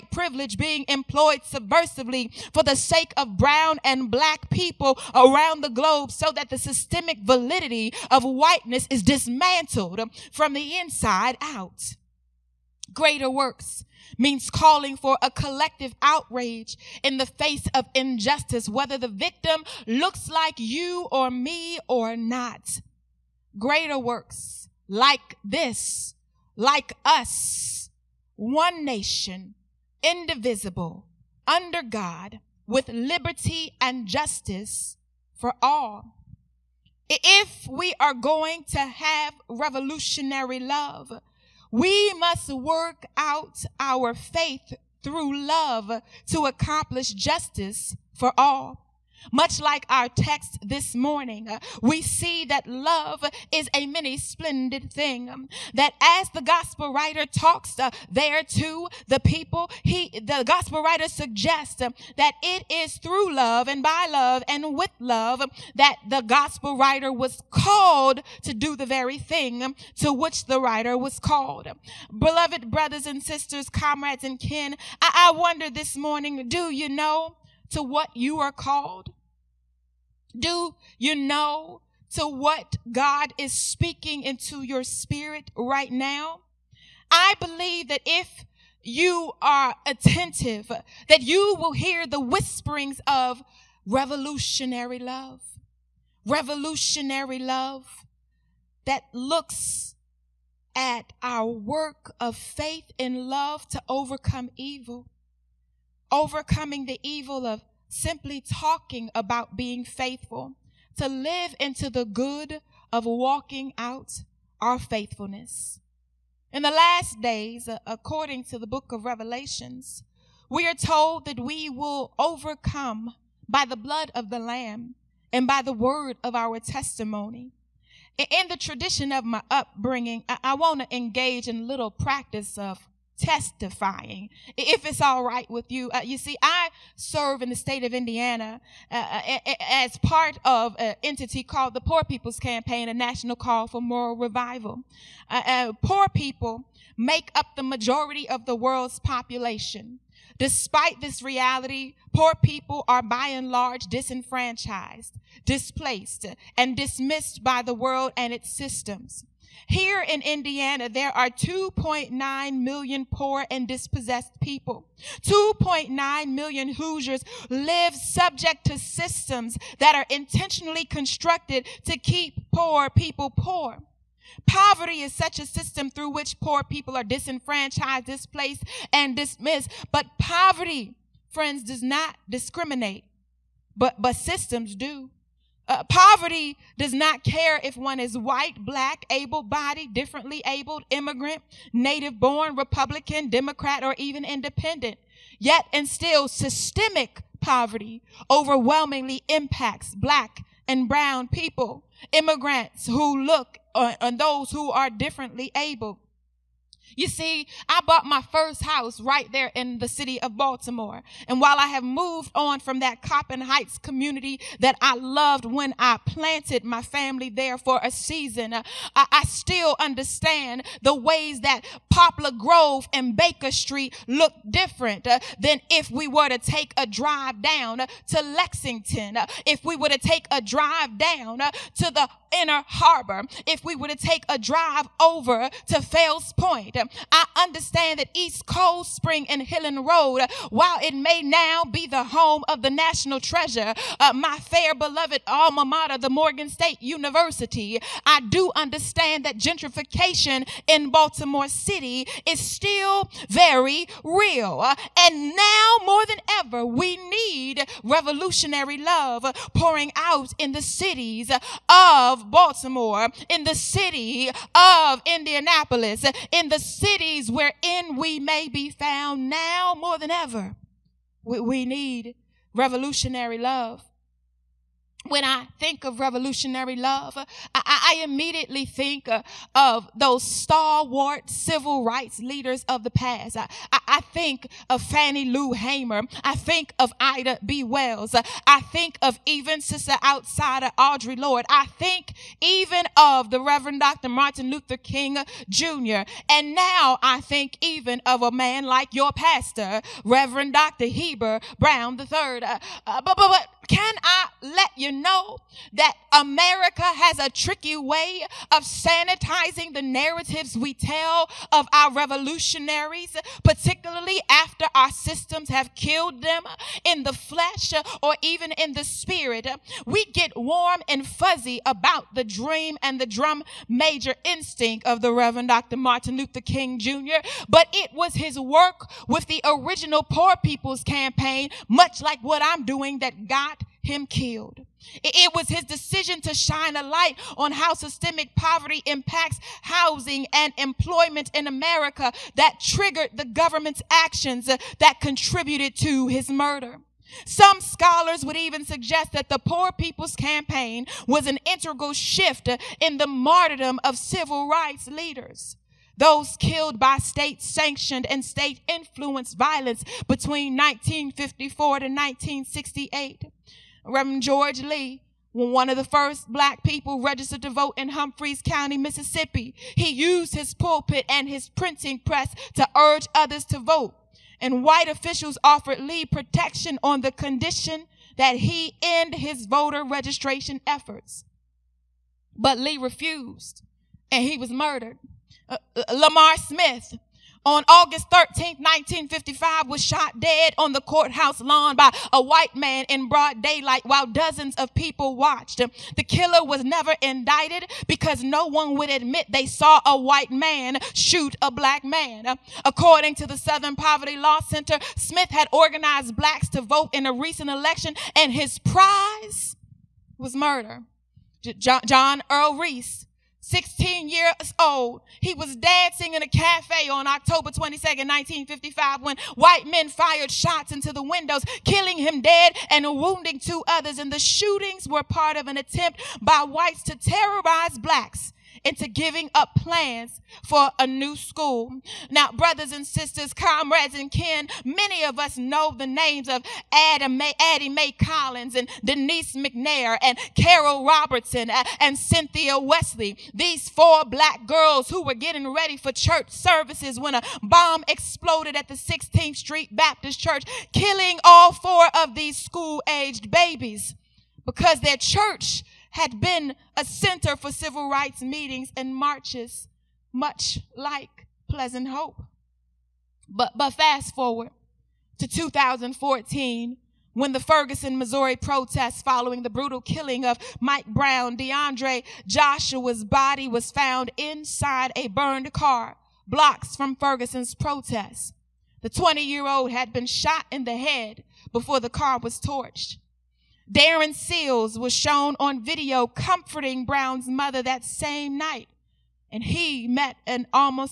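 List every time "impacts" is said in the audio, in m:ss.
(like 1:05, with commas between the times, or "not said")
3:19, 5:38.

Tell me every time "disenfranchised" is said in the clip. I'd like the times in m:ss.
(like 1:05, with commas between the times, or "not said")
2:33, 2:57.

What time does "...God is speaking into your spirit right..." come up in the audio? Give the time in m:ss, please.
1:22.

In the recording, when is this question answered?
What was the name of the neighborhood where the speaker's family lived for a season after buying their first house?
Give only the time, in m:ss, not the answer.
3:33.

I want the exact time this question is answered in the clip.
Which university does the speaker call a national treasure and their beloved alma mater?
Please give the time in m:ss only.
4:06.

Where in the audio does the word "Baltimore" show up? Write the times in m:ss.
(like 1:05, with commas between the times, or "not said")
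3:30, 4:10, 4:22.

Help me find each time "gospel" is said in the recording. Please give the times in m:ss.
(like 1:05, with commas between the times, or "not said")
0:56, 1:00, 1:06.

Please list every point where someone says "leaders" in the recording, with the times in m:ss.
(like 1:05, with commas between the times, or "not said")
4:42, 5:54.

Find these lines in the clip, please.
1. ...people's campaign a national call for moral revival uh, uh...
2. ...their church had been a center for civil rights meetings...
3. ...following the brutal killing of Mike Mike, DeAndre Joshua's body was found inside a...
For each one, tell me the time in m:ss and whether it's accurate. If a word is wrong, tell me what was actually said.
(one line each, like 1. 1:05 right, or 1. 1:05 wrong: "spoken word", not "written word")
1. 2:22 right
2. 7:34 right
3. 7:49 wrong: "Brown", not "Mike".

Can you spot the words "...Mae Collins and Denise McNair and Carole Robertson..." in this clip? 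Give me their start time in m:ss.
7:17.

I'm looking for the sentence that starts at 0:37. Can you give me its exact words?
If we are going to have revolutionary love, we must work out our faith through love to accomplish justice for all.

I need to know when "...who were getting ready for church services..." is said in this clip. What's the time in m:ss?
7:24.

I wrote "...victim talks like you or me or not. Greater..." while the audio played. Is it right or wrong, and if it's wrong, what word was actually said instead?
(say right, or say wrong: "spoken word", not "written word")
wrong: "looks", not "talks".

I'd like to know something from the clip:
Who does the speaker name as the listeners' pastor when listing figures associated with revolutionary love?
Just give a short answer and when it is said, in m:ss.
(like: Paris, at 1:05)
Heber Brown III, at 5:00.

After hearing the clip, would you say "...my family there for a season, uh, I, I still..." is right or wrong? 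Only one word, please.
right.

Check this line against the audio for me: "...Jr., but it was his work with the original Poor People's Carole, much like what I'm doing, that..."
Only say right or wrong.
wrong.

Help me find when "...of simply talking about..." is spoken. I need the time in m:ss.
1:47.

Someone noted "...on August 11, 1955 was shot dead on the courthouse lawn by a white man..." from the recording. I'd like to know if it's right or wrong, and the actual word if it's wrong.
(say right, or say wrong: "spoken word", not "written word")
wrong: "13", not "11".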